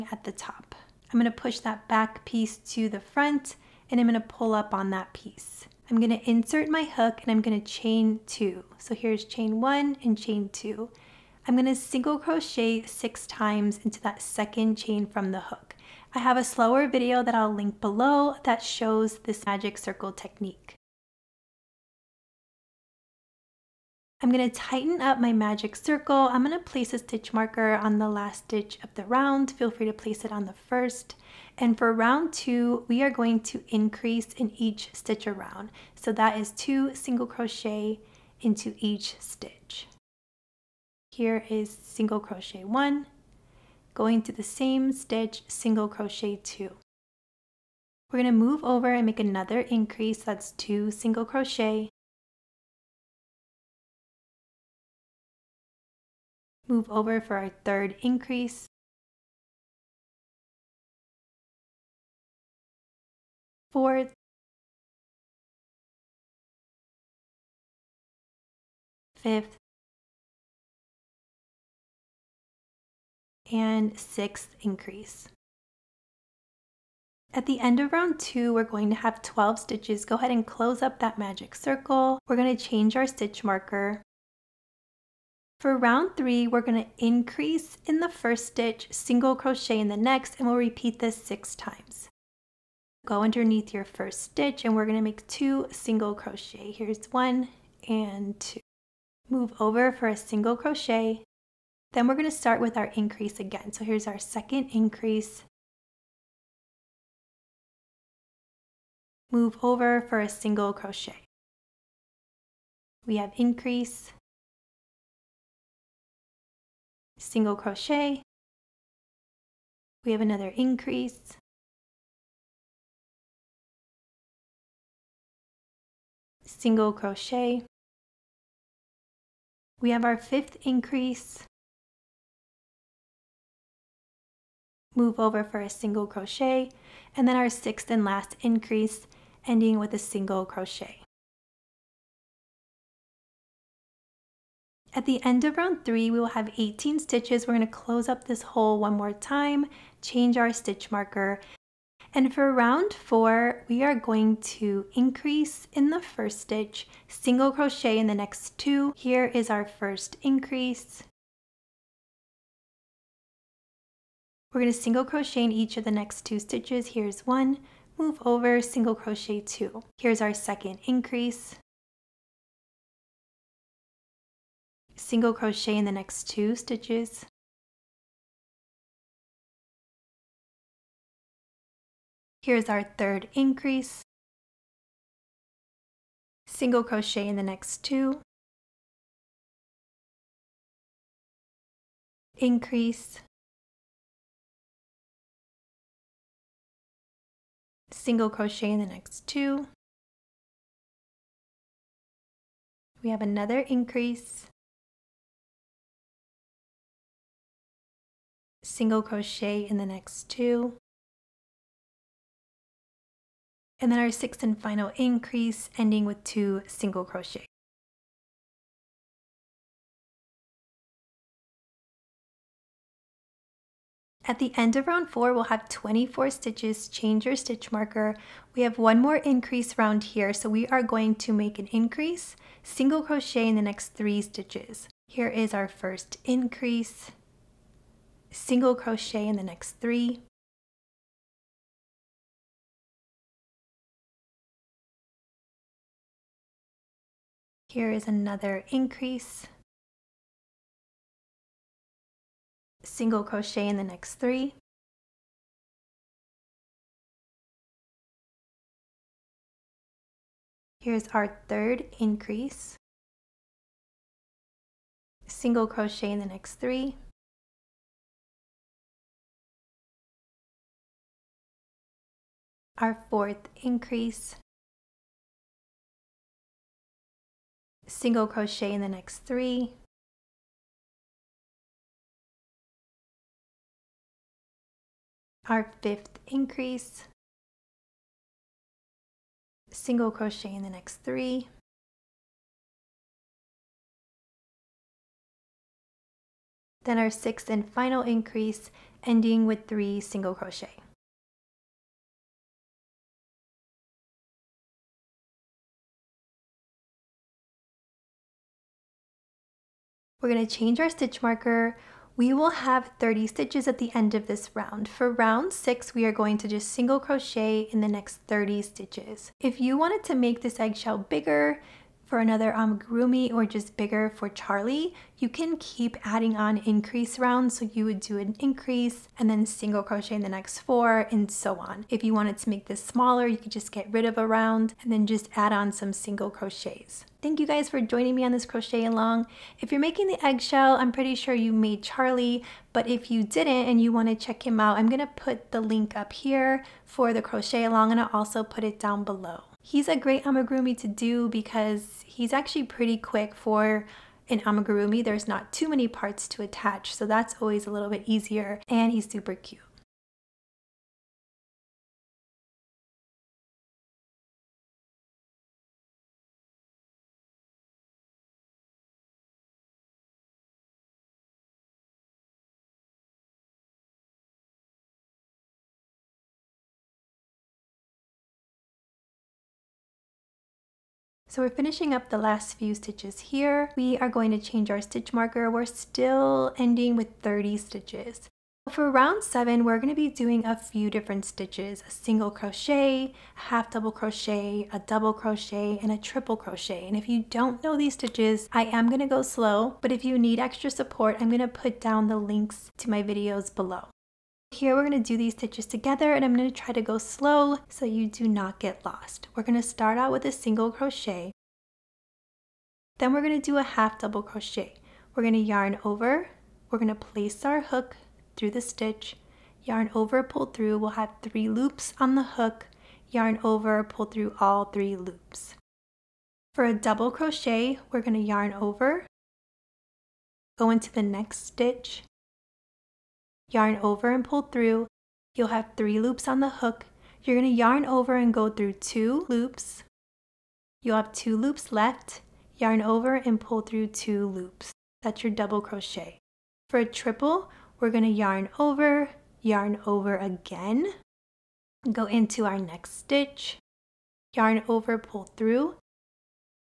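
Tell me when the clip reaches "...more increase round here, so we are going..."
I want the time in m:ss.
3:49.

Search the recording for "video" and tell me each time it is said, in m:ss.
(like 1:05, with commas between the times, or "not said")
0:16, 6:43.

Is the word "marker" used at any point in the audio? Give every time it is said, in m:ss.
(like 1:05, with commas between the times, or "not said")
0:27, 1:23, 2:30, 3:47, 5:11, 6:25.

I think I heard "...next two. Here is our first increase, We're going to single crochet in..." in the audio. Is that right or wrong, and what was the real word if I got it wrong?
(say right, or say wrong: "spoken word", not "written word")
right.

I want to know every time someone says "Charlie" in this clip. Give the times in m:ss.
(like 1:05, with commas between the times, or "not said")
5:24, 5:41.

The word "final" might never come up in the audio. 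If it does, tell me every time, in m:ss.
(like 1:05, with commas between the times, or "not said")
3:34, 4:57.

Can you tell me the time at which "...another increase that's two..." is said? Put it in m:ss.
0:49.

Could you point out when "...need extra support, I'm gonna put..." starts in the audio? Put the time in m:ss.
6:40.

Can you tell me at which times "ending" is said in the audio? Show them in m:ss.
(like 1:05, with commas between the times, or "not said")
2:19, 3:35, 4:59, 6:26.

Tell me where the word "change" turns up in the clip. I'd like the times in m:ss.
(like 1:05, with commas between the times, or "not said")
1:22, 2:30, 3:46, 5:10, 6:24.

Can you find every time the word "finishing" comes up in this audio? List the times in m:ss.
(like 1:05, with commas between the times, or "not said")
6:21.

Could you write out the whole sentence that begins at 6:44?
Here we're gonna do these stitches together and I'm gonna try to go slow so you do not get lost.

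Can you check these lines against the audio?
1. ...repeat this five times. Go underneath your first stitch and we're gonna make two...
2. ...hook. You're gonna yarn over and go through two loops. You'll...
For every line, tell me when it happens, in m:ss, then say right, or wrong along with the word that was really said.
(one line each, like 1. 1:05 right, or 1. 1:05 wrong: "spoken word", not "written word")
1. 1:30 wrong: "six", not "five"
2. 7:16 right.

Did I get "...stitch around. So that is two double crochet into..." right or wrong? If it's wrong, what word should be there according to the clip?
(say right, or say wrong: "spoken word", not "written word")
wrong: "single", not "double".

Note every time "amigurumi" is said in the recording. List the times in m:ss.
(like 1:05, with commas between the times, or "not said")
5:50, 5:54.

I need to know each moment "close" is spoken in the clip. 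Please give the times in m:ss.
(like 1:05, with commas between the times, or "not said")
1:20, 2:27.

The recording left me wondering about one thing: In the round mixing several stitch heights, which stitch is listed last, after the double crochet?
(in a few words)
Triple crochet.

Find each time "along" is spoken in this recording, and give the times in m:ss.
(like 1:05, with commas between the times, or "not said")
5:38, 5:47.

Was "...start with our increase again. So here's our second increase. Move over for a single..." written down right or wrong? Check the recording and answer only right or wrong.
right.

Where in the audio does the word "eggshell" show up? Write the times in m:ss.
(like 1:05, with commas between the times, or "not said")
5:20, 5:40.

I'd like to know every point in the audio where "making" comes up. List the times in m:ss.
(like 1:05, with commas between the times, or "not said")
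5:39.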